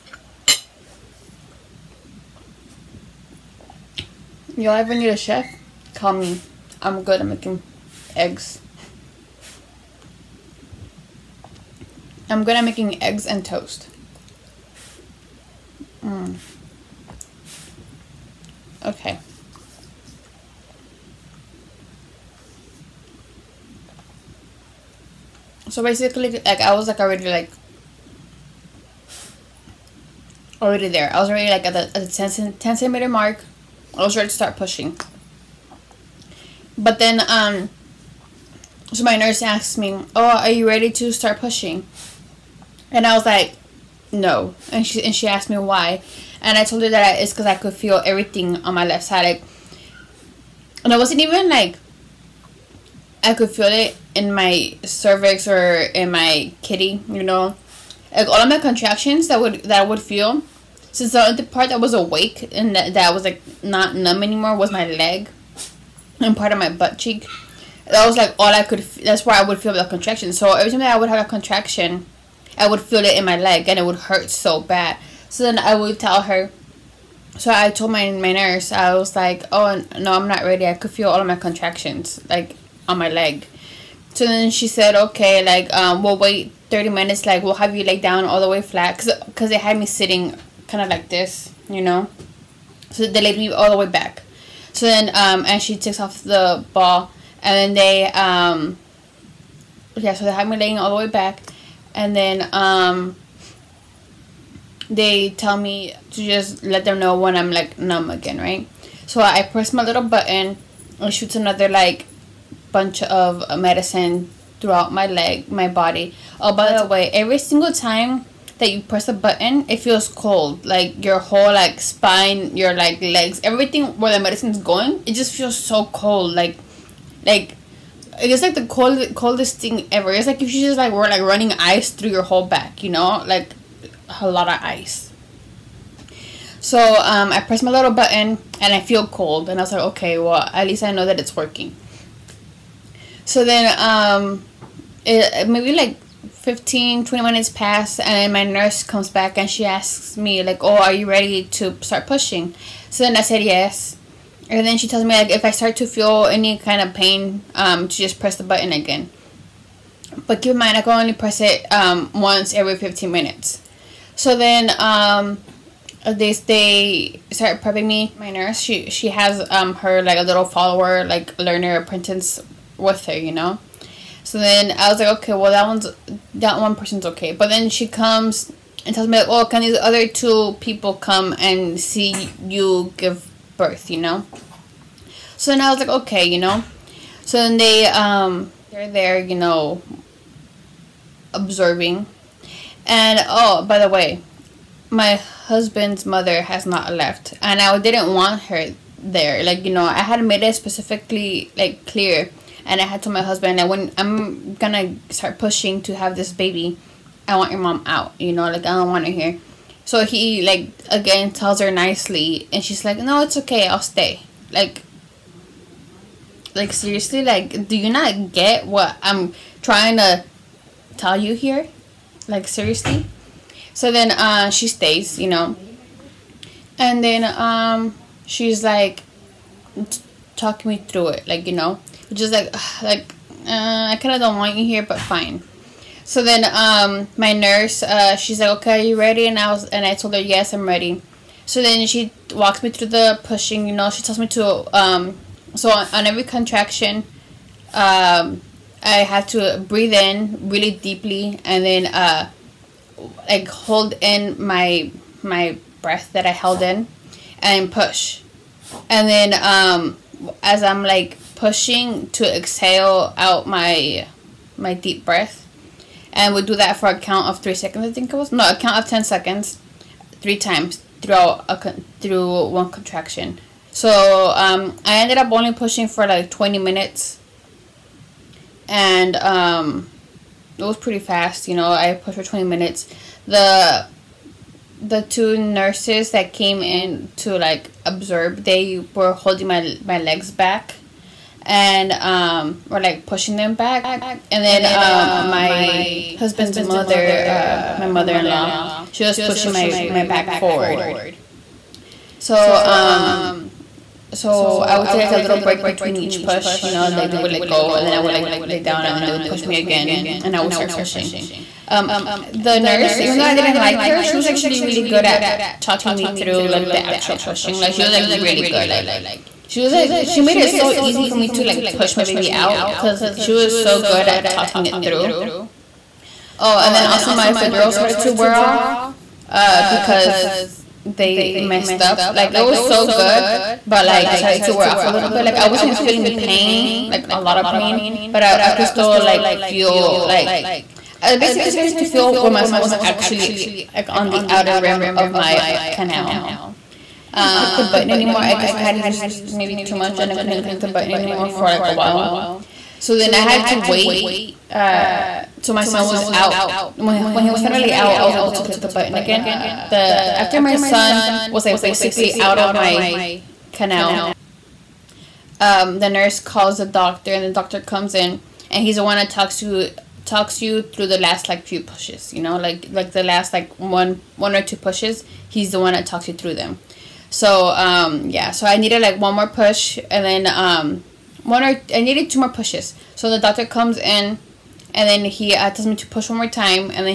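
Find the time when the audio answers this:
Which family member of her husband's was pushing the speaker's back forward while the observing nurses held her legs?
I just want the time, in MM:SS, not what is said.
04:57.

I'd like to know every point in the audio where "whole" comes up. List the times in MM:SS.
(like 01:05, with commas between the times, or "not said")
02:01, 02:12.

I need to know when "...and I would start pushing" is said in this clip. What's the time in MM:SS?
05:10.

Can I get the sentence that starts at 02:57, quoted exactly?
But then she comes and tells me, like, oh, can these other two people come and see you give birth, you know?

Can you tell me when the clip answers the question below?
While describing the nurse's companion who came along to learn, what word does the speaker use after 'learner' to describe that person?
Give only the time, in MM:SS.
02:51.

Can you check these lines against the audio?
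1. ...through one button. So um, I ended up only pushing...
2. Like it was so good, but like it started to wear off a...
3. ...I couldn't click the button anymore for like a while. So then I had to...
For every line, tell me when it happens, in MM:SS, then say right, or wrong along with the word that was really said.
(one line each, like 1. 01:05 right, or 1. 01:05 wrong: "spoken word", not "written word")
1. 04:31 wrong: "contraction", not "button"
2. 05:32 right
3. 05:50 right.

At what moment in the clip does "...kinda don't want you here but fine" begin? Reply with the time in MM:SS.
03:53.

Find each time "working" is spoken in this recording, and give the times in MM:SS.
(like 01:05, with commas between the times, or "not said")
02:21.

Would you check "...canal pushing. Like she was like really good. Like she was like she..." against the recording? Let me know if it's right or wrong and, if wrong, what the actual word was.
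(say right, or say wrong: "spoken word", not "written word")
wrong: "actual", not "canal".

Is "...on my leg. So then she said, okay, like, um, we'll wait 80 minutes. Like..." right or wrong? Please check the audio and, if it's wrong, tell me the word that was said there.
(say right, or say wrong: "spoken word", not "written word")
wrong: "30", not "80".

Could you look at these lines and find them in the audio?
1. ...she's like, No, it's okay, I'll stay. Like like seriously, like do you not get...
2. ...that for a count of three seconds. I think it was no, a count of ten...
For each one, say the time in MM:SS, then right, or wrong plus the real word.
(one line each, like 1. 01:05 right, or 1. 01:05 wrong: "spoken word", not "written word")
1. 03:32 right
2. 04:26 right.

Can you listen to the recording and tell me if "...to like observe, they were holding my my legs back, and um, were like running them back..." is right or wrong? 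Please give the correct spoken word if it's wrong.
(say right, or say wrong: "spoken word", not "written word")
wrong: "pushing", not "running".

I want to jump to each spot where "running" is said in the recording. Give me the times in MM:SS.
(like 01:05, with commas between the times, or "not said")
02:11.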